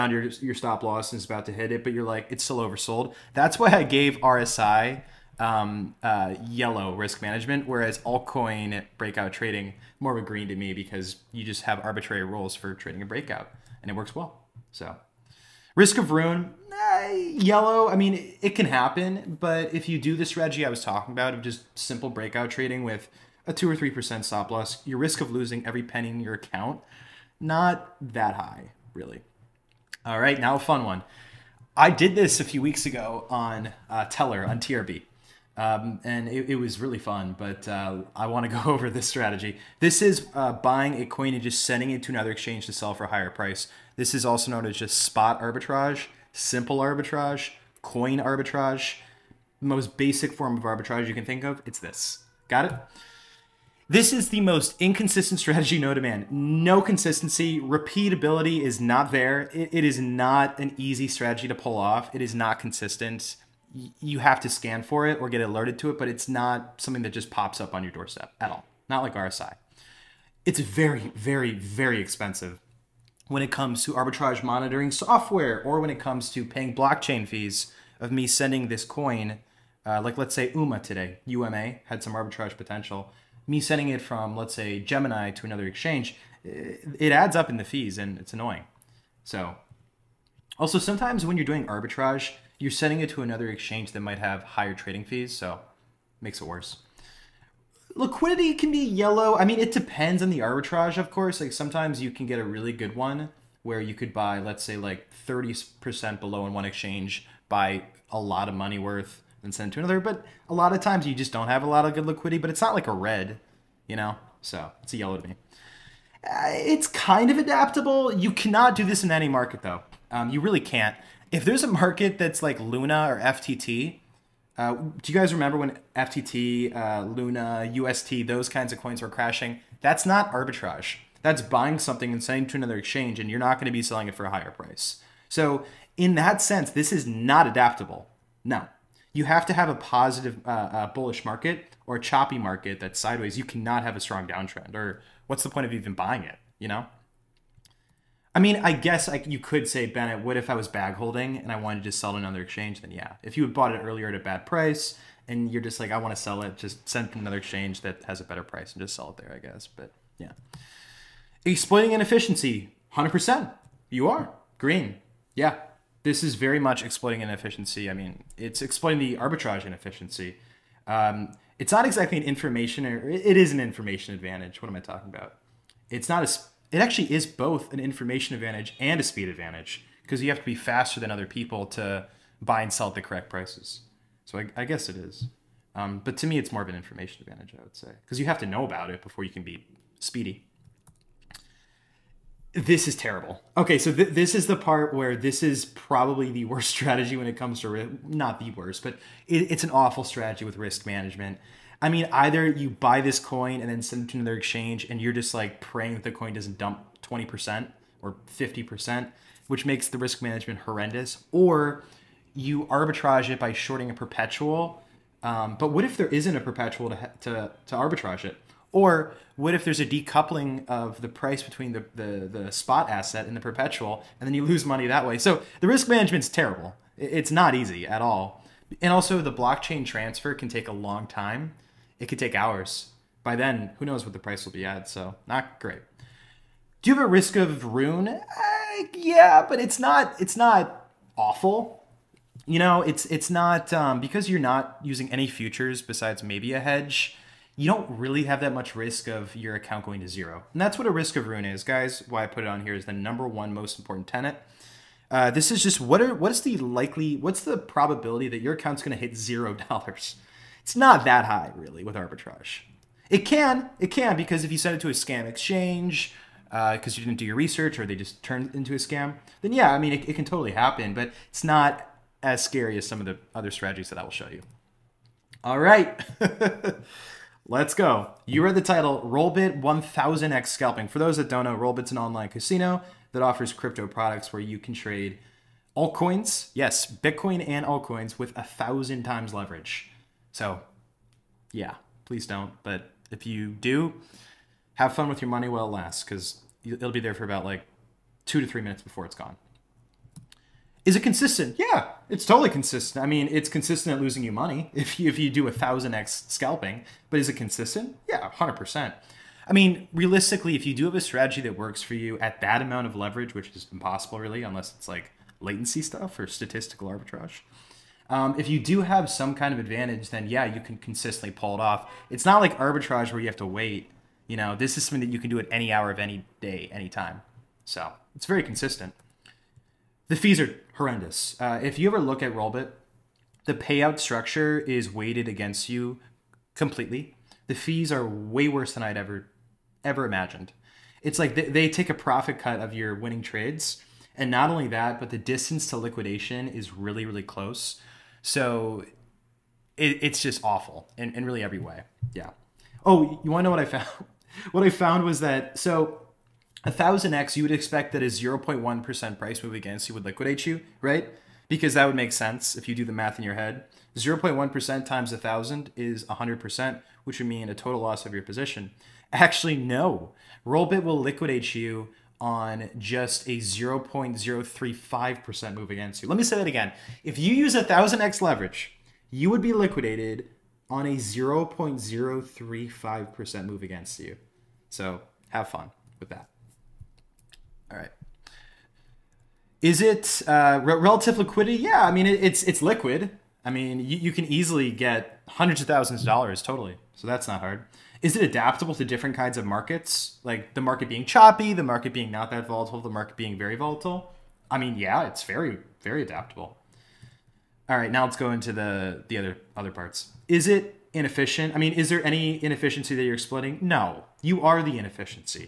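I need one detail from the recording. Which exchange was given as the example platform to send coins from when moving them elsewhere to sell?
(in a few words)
Gemini.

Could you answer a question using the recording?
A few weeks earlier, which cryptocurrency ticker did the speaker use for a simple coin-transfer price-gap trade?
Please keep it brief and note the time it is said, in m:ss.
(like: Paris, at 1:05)
TRB, at 0:34.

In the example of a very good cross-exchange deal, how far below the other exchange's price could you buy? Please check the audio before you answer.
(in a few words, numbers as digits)
30%.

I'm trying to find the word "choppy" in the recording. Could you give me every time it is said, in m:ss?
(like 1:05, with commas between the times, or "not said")
2:21, 6:41.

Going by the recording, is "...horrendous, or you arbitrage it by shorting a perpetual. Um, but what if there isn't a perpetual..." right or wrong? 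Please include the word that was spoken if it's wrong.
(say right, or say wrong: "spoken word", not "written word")
right.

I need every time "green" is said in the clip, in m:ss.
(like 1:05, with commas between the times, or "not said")
0:10, 2:44.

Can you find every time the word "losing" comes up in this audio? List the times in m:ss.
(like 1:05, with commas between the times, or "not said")
0:25, 5:04.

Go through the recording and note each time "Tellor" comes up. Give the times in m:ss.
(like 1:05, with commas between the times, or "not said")
0:34.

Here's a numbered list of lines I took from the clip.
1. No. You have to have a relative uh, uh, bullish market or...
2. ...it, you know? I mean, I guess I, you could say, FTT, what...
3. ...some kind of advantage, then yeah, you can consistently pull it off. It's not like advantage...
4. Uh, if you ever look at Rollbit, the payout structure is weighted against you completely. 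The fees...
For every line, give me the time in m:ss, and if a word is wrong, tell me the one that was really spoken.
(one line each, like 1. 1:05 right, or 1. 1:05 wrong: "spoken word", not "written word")
1. 2:18 wrong: "positive", not "relative"
2. 2:26 wrong: "Bennett", not "FTT"
3. 5:19 wrong: "arbitrage", not "advantage"
4. 5:31 right.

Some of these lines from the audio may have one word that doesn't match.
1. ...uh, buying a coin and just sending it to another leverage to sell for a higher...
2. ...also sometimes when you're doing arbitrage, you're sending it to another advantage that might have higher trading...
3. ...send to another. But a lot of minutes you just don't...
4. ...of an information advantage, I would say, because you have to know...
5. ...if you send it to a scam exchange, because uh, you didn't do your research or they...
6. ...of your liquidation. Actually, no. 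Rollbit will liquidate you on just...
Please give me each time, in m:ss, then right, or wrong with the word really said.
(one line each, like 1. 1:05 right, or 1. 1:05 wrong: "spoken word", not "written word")
1. 0:40 wrong: "exchange", not "leverage"
2. 1:30 wrong: "exchange", not "advantage"
3. 1:49 wrong: "times", not "minutes"
4. 3:06 right
5. 4:24 right
6. 6:08 wrong: "position", not "liquidation".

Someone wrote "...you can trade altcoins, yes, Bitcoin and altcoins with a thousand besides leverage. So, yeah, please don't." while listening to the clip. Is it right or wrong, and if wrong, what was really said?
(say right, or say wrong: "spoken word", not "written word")
wrong: "times", not "besides".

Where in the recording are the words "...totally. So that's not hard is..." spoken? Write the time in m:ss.
6:36.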